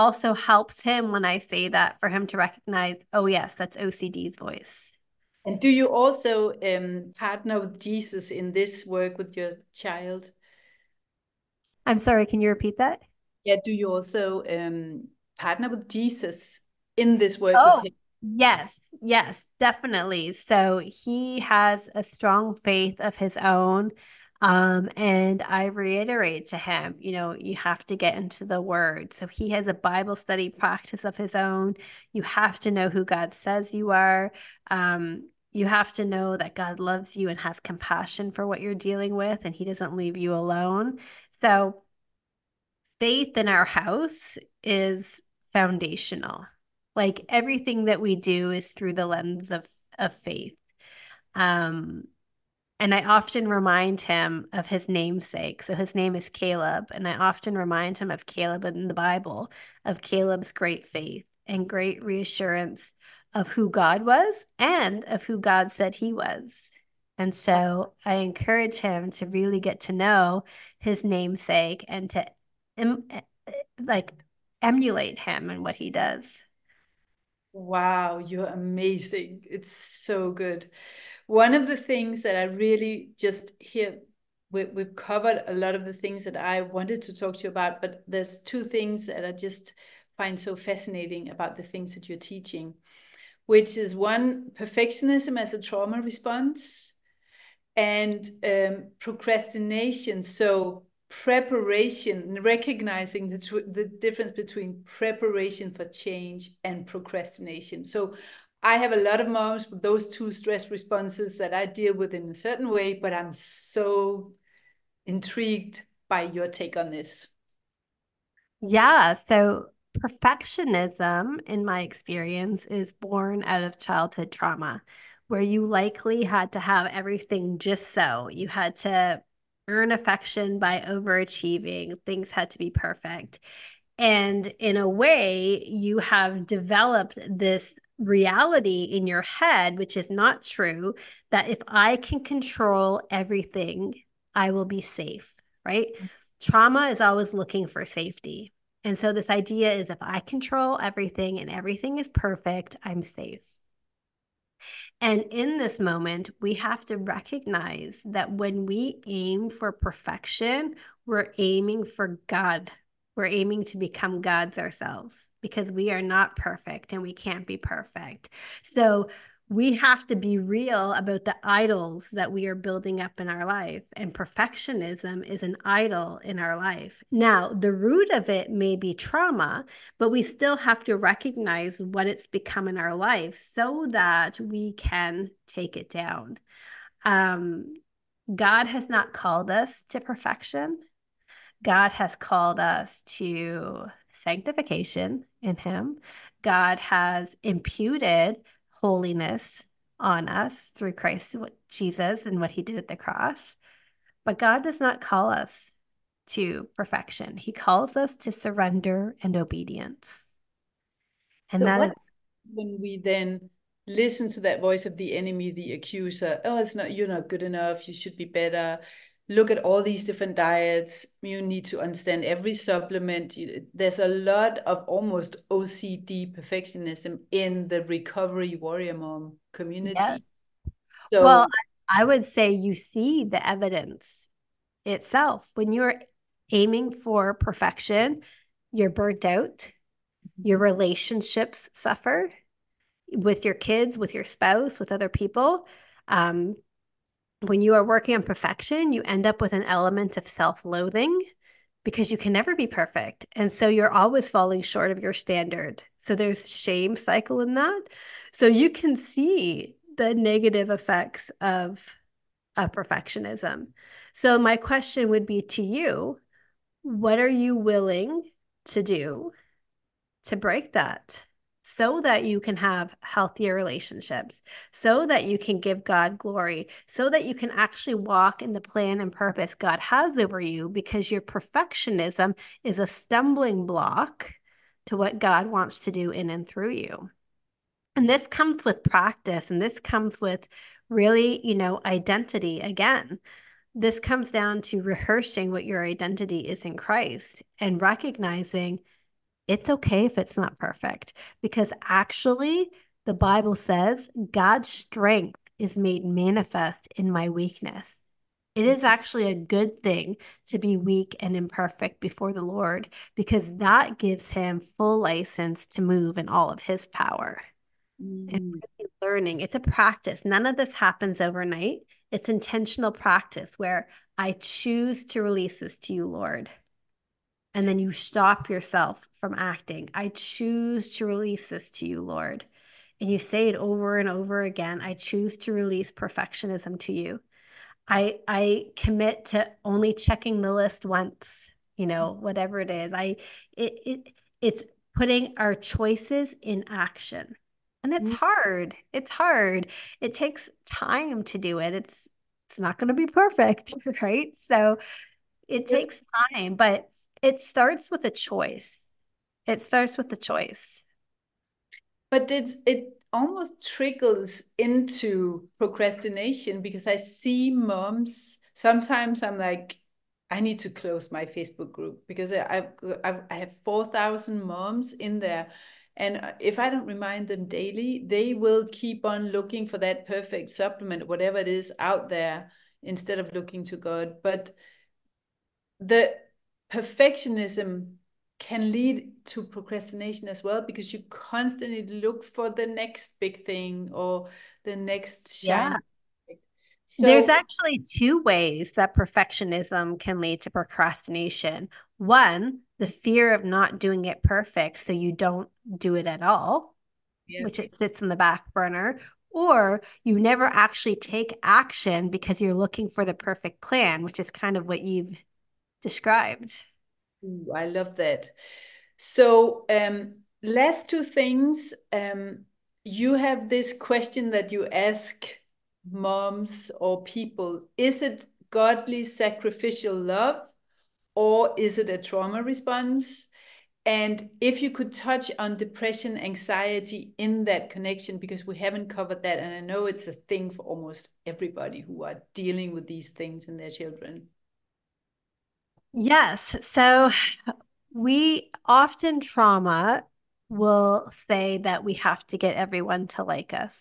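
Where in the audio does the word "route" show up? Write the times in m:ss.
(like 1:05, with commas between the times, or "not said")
not said.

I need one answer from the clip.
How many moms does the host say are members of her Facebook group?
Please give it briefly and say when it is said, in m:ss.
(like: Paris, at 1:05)
4,000, at 6:13.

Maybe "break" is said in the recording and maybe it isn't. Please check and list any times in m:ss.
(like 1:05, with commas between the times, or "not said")
4:30.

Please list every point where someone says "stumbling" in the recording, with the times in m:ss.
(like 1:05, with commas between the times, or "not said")
4:42.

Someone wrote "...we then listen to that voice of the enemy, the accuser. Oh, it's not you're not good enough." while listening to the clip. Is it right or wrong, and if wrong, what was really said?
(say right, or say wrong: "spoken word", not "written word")
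right.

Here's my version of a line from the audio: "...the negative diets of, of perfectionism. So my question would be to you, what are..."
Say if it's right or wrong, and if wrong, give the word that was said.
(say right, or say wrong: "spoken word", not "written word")
wrong: "effects", not "diets".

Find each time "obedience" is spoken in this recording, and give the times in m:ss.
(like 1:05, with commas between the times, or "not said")
3:29.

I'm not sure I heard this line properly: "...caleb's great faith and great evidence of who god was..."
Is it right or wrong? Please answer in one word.
wrong.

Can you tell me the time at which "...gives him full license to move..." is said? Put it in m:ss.
5:13.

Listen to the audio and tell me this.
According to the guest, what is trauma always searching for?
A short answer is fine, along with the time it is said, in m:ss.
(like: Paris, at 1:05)
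safety, at 2:27.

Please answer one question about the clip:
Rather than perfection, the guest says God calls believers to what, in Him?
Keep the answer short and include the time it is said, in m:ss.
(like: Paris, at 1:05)
sanctification, at 3:14.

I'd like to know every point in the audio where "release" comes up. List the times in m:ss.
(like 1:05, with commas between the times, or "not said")
5:25, 5:31, 5:35.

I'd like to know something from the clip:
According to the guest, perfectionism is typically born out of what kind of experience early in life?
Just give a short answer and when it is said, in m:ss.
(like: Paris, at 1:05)
childhood trauma, at 2:03.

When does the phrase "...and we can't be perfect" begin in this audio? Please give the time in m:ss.
2:46.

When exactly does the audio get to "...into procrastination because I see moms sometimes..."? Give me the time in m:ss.
6:04.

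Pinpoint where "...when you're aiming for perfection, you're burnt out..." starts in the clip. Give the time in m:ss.
3:55.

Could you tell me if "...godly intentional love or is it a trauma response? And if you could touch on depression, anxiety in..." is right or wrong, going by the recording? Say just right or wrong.
wrong.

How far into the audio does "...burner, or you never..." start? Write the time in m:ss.
6:48.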